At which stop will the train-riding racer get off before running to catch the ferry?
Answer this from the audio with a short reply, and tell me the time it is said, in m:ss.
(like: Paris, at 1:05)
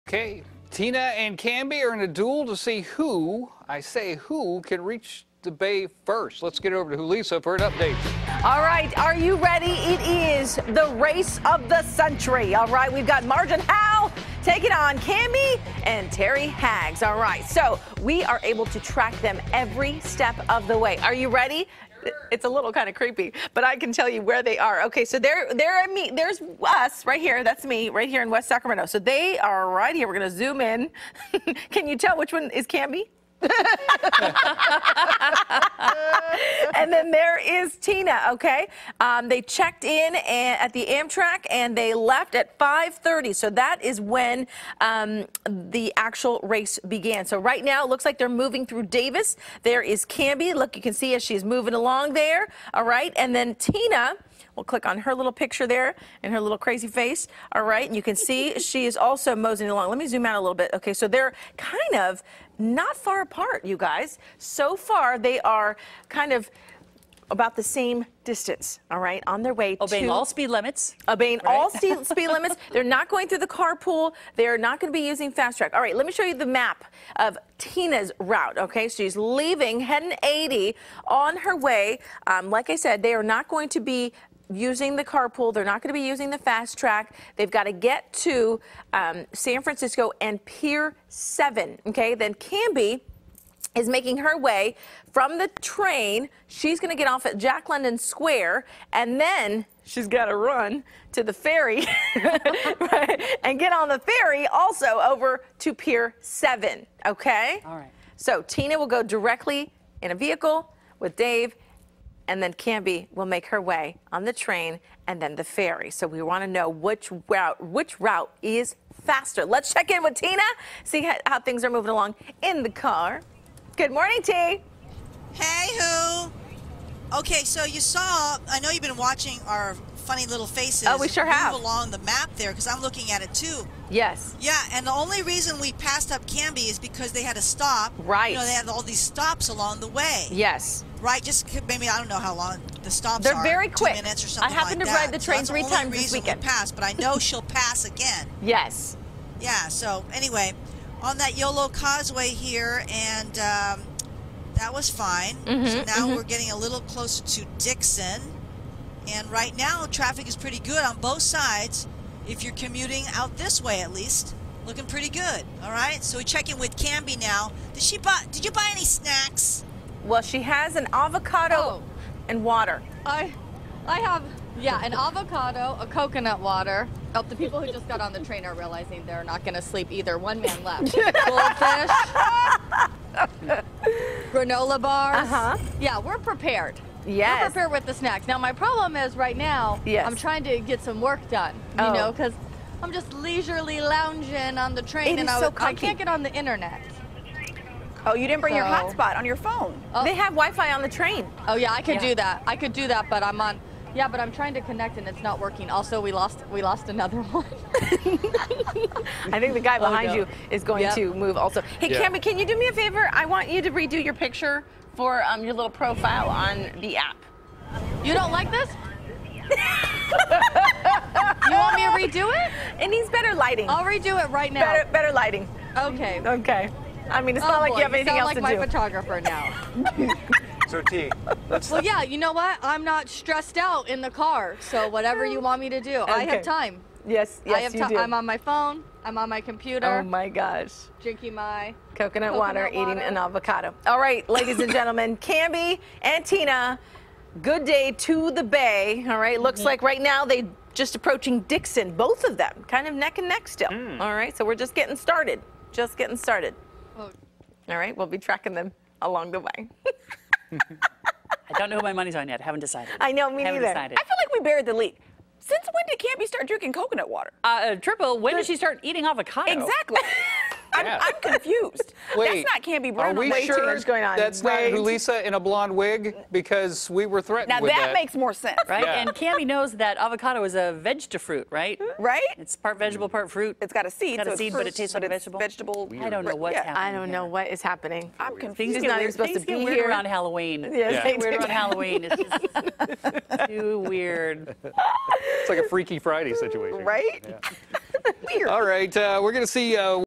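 Jack London Square, at 1:37.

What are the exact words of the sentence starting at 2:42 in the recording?
If you're commuting out this way, at least looking pretty good.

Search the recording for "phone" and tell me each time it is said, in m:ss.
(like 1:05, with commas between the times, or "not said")
3:19, 3:58.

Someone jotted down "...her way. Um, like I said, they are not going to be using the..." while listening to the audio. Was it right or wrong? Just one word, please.
right.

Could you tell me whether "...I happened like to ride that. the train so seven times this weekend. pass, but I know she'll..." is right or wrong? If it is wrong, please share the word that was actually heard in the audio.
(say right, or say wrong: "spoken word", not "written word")
wrong: "three", not "seven".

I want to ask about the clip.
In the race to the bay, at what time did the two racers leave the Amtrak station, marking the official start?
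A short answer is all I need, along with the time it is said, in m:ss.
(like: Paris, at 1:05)
5:30, at 0:42.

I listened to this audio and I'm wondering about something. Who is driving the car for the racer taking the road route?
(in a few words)
Dave.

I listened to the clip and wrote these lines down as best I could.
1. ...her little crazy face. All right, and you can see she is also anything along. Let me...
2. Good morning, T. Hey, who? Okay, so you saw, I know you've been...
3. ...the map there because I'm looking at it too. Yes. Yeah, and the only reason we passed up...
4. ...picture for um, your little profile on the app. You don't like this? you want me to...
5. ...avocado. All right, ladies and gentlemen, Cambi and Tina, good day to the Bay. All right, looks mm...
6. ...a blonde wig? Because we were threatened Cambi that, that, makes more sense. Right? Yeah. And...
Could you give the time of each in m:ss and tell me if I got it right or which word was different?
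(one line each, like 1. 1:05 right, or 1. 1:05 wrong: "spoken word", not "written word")
1. 0:56 wrong: "moseying", not "anything"
2. 2:03 right
3. 2:11 right
4. 3:34 right
5. 4:03 right
6. 4:35 wrong: "Now", not "Cambi".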